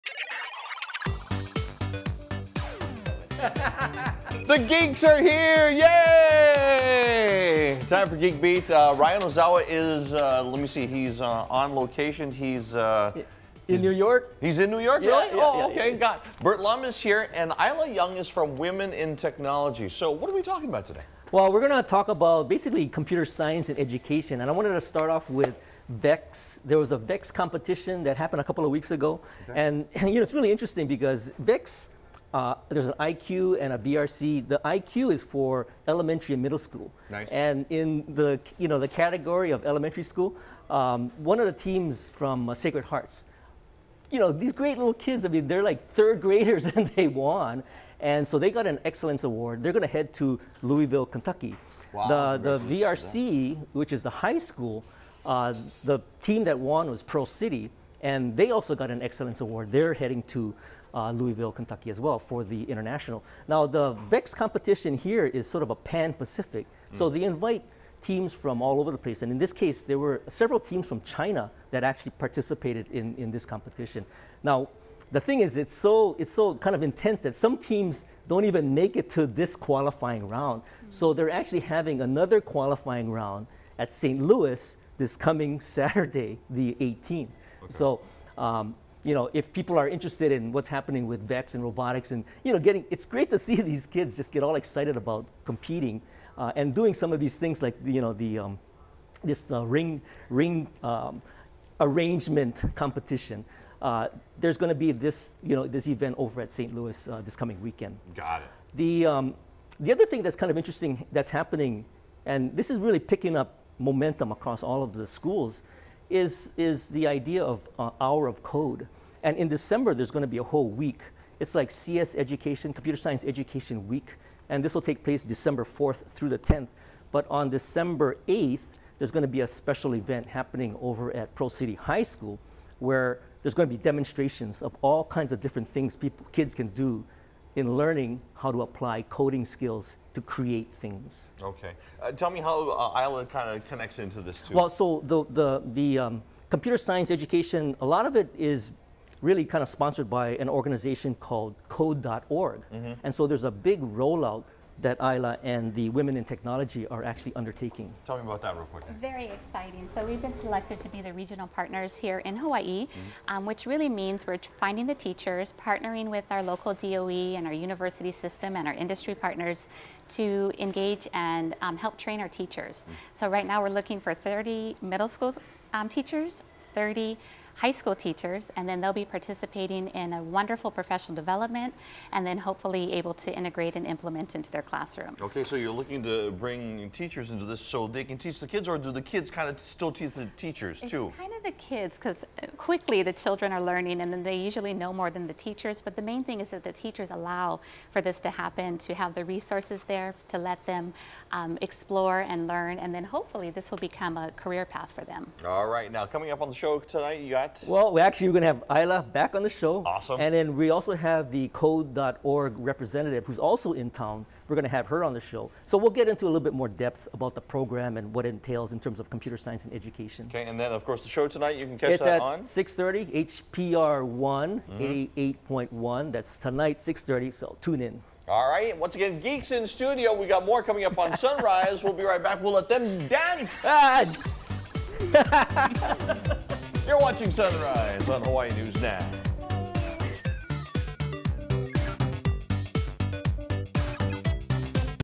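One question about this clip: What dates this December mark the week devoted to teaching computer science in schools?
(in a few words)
December 4th through the 10th.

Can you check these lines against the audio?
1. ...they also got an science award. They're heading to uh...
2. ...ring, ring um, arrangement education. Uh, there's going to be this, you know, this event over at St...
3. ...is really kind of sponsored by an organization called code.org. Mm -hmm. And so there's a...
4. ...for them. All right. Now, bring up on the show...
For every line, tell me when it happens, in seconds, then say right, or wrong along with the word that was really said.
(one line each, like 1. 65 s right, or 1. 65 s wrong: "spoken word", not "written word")
1. 58 s wrong: "excellence", not "science"
2. 99 s wrong: "competition", not "education"
3. 148 s right
4. 204 s wrong: "coming", not "bring".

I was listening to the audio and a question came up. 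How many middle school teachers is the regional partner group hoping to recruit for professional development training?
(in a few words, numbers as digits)
30.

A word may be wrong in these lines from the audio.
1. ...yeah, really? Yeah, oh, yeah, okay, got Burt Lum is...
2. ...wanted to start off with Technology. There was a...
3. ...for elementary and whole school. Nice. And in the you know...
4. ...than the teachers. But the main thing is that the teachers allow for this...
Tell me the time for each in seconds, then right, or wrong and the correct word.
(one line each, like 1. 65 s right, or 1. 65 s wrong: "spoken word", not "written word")
1. 15 s right
2. 24 s wrong: "VEX", not "Technology"
3. 35 s wrong: "middle", not "whole"
4. 195 s right.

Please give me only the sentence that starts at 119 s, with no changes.
And in December, there's going to be a whole week.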